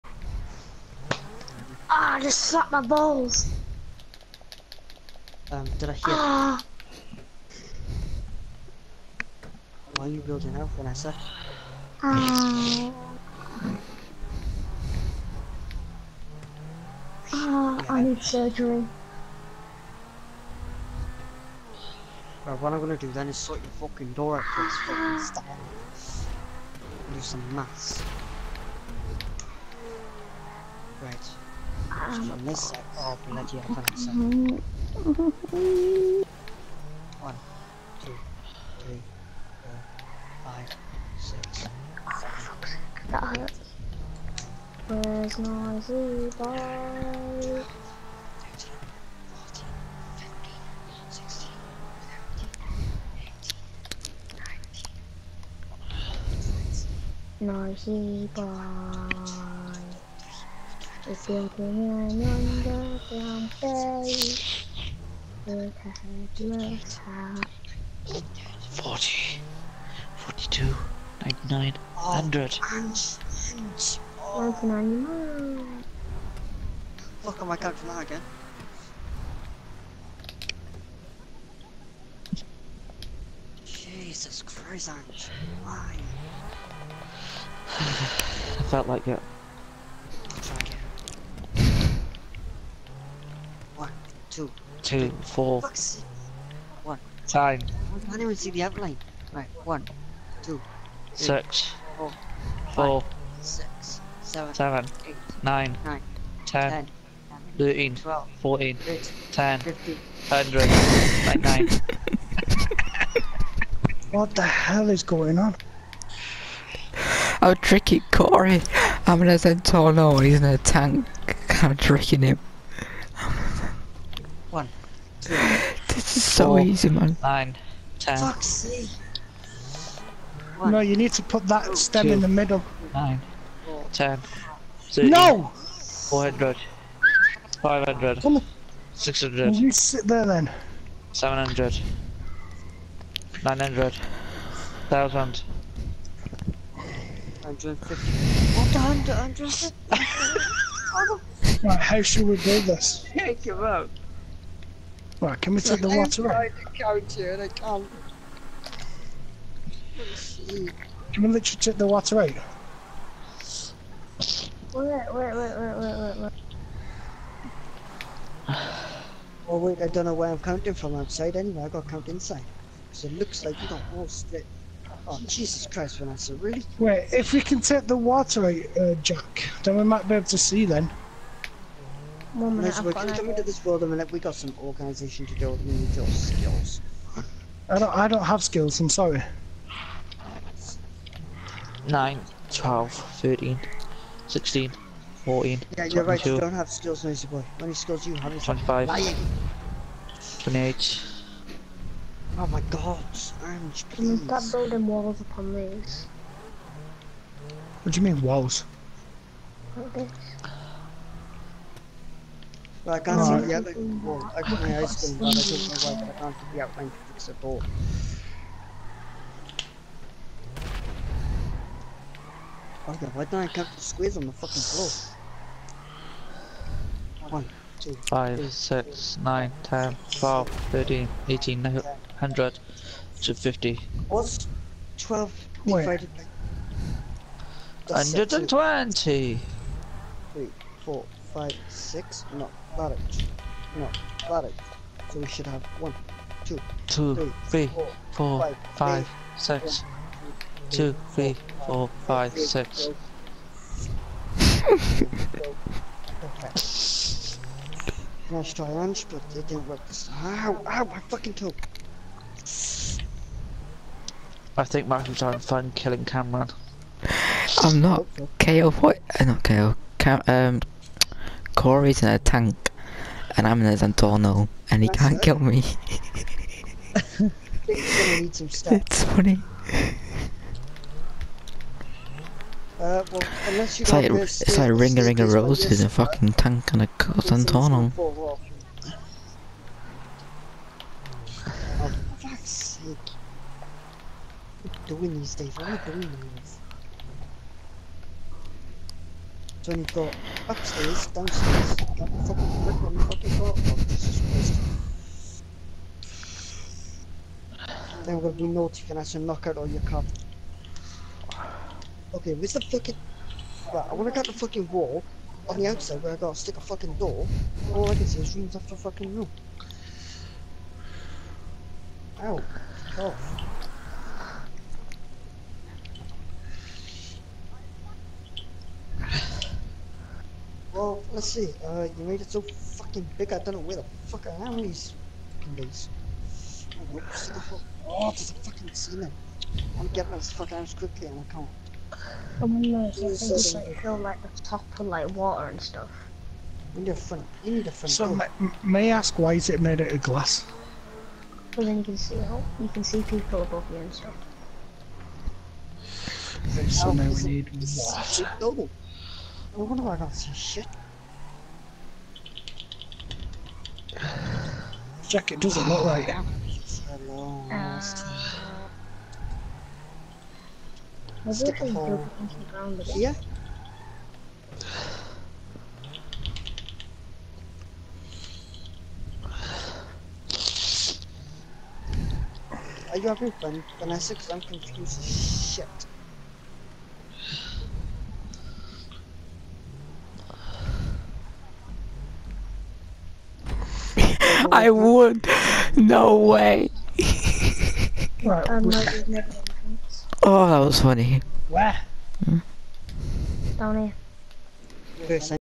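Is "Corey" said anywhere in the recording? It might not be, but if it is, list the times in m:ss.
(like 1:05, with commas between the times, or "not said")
1:58, 4:31.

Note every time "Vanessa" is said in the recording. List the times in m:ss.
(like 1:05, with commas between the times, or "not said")
0:10, 2:55, 6:23.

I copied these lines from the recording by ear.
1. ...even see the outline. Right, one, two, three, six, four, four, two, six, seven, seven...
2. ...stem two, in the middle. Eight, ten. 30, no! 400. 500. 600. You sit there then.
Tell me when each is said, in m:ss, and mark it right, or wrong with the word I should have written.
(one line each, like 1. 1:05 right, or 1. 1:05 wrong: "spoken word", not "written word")
1. 1:38 wrong: "five", not "two"
2. 2:11 wrong: "Nine", not "Eight".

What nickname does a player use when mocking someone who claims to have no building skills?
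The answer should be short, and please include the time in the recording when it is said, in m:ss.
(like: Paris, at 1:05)
Noisy Boy, at 3:17.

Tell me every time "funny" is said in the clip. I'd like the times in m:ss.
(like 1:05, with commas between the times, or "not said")
4:39, 6:40.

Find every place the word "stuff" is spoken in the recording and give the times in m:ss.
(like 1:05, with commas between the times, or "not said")
5:45, 5:53.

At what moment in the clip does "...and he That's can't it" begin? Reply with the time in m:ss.
4:34.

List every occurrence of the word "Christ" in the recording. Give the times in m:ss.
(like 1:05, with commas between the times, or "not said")
2:55, 5:07.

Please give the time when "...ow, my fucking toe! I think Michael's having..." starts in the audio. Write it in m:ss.
4:20.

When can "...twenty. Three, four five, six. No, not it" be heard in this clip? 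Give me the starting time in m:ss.
3:58.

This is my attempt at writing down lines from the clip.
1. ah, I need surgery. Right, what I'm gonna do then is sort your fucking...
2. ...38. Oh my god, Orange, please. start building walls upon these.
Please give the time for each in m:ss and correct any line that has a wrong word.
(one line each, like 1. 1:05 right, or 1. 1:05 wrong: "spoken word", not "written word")
1. 0:17 right
2. 3:20 wrong: "28", not "38".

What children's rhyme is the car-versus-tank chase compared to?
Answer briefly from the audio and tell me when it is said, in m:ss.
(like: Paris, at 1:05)
Ring a Ring of Roses, at 4:44.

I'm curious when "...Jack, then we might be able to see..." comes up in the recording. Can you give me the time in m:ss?
2:59.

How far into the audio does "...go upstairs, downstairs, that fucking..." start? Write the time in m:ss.
4:59.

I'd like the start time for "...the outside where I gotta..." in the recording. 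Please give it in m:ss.
5:15.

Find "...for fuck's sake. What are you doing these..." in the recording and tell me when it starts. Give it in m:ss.
4:51.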